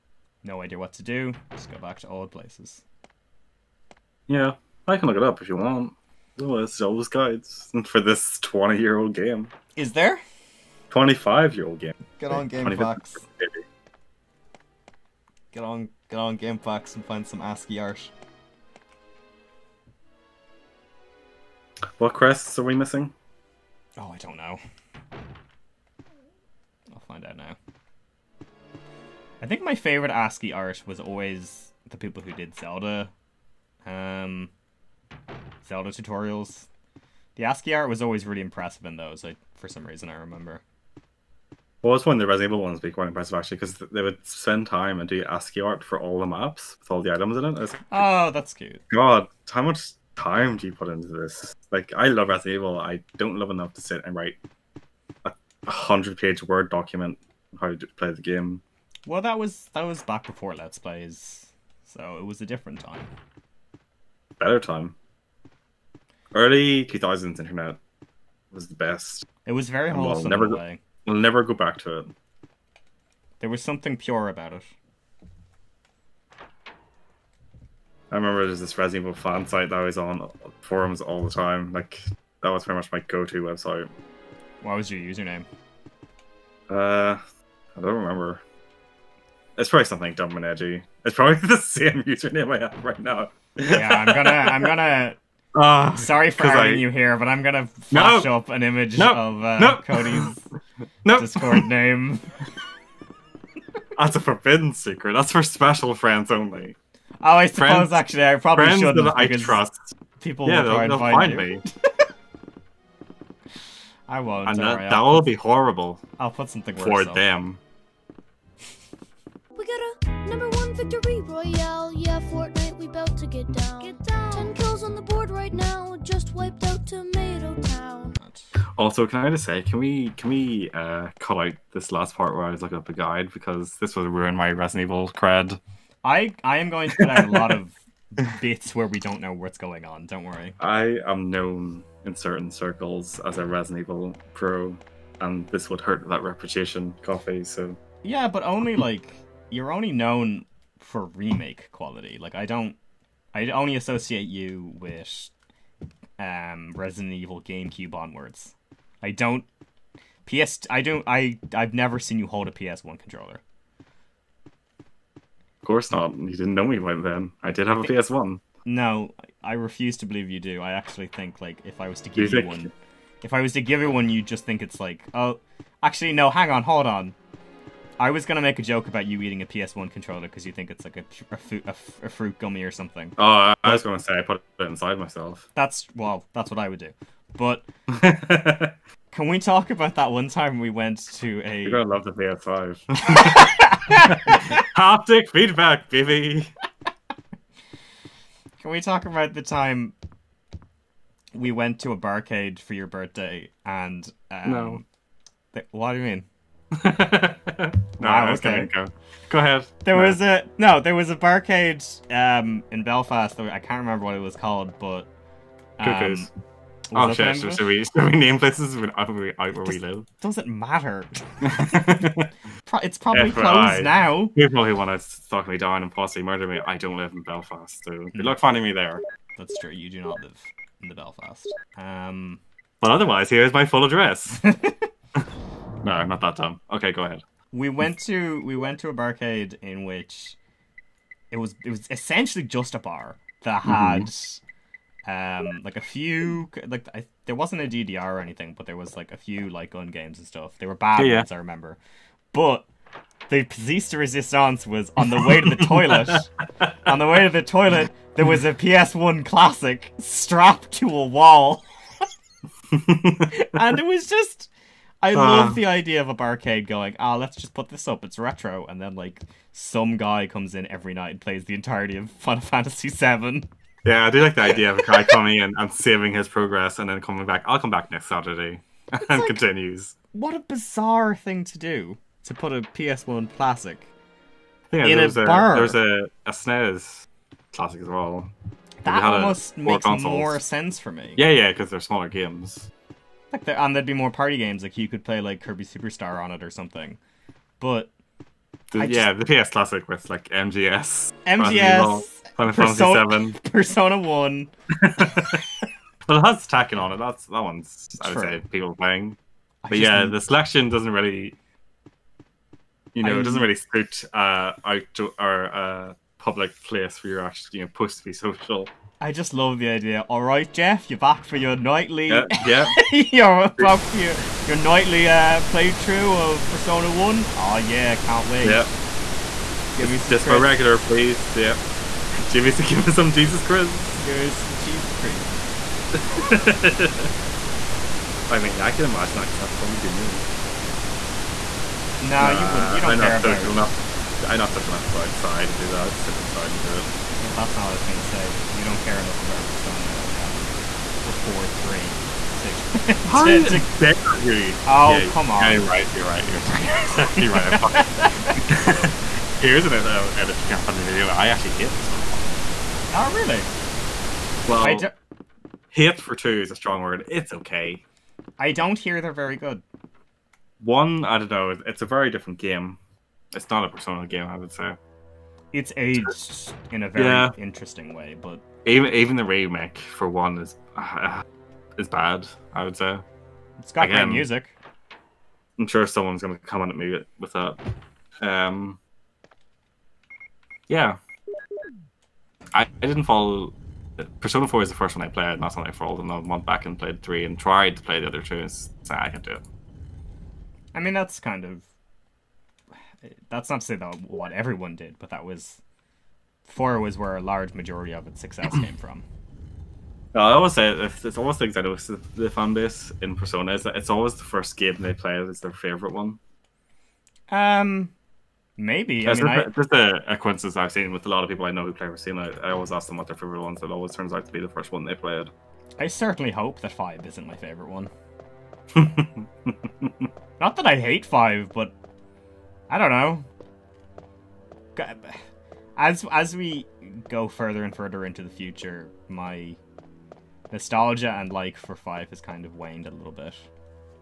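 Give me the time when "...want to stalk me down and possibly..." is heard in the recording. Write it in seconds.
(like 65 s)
224 s.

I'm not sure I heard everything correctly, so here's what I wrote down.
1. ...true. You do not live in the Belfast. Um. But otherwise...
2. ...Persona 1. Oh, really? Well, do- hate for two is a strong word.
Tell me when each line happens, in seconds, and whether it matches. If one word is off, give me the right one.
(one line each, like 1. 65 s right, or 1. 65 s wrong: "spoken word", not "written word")
1. 229 s right
2. 361 s right.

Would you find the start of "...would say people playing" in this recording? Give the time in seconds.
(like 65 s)
308 s.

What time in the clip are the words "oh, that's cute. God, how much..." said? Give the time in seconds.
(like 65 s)
47 s.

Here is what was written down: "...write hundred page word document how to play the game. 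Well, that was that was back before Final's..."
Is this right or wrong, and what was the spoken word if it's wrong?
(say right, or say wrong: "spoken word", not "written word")
wrong: "Let", not "Final".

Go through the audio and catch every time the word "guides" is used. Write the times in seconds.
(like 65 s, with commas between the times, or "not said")
7 s, 132 s.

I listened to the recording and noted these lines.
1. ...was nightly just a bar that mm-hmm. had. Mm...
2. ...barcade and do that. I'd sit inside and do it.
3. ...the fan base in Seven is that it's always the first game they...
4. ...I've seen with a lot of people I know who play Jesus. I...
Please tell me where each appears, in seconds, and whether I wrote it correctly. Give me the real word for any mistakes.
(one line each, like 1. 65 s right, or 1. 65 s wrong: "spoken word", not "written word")
1. 241 s wrong: "essentially", not "nightly"
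2. 345 s wrong: "outside", not "barcade"
3. 412 s wrong: "Persona", not "Seven"
4. 420 s wrong: "Racine", not "Jesus".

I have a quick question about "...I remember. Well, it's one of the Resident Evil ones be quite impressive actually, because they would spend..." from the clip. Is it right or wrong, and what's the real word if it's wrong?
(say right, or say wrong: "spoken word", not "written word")
right.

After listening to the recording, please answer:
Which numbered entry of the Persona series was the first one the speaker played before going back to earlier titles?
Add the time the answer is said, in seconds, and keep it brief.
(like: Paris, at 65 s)
Persona 4, at 394 s.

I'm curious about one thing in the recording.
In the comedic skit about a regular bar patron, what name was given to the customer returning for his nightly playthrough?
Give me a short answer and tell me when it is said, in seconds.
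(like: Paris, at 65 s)
Jeff, at 320 s.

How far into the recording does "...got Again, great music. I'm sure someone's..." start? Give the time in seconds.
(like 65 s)
383 s.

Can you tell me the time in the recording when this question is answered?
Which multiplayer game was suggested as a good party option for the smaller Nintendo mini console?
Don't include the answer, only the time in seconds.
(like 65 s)
295 s.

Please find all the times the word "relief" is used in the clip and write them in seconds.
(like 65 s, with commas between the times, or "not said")
not said.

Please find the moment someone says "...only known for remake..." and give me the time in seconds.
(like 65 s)
149 s.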